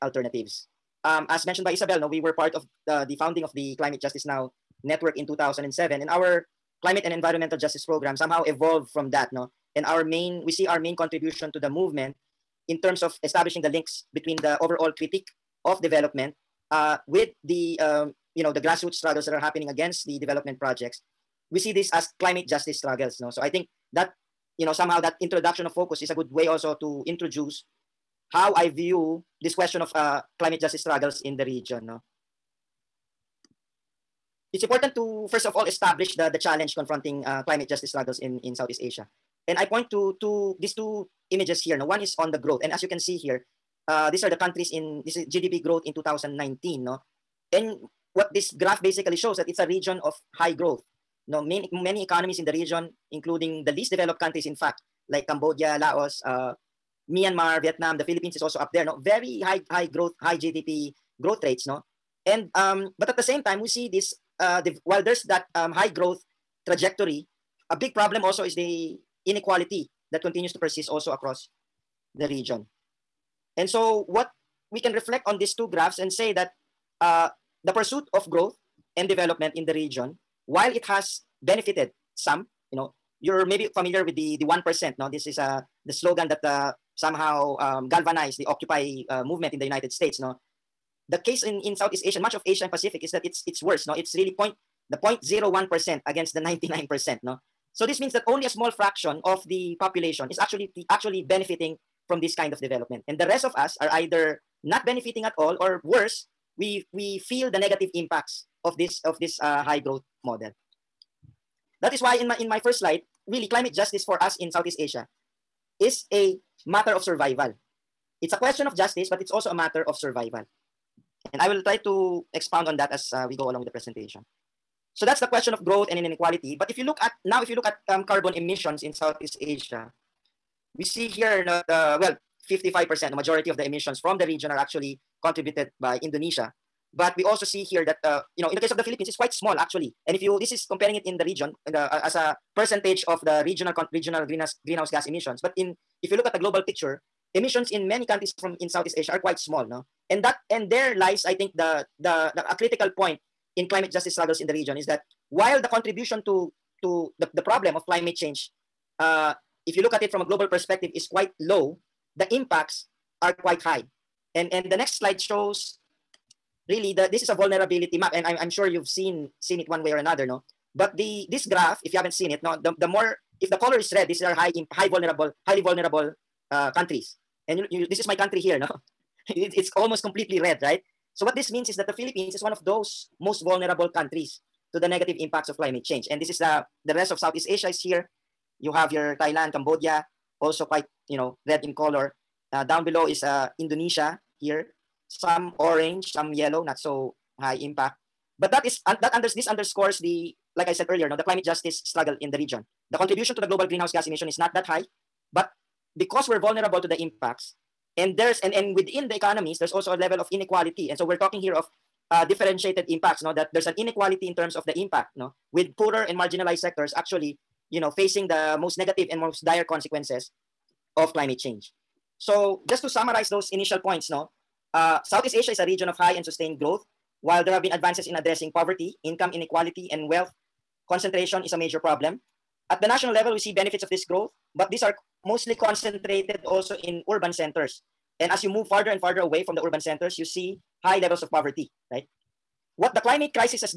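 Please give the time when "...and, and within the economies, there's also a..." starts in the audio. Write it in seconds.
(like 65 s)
208 s.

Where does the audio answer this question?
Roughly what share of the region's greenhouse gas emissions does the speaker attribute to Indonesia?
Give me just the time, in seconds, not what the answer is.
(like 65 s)
132 s.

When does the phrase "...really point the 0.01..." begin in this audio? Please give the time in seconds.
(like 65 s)
94 s.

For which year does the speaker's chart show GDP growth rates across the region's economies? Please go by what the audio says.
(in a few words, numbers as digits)
2019.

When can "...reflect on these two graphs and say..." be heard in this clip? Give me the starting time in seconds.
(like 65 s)
74 s.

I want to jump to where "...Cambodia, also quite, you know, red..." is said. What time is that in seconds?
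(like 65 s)
189 s.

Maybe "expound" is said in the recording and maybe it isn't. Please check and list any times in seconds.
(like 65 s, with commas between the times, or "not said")
122 s.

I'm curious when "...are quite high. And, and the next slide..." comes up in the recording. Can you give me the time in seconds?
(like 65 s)
163 s.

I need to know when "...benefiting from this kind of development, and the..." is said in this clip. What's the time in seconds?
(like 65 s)
101 s.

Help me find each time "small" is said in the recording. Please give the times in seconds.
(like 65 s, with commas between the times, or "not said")
98 s, 139 s, 149 s.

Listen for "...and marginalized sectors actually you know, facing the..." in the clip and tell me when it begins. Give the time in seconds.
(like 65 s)
216 s.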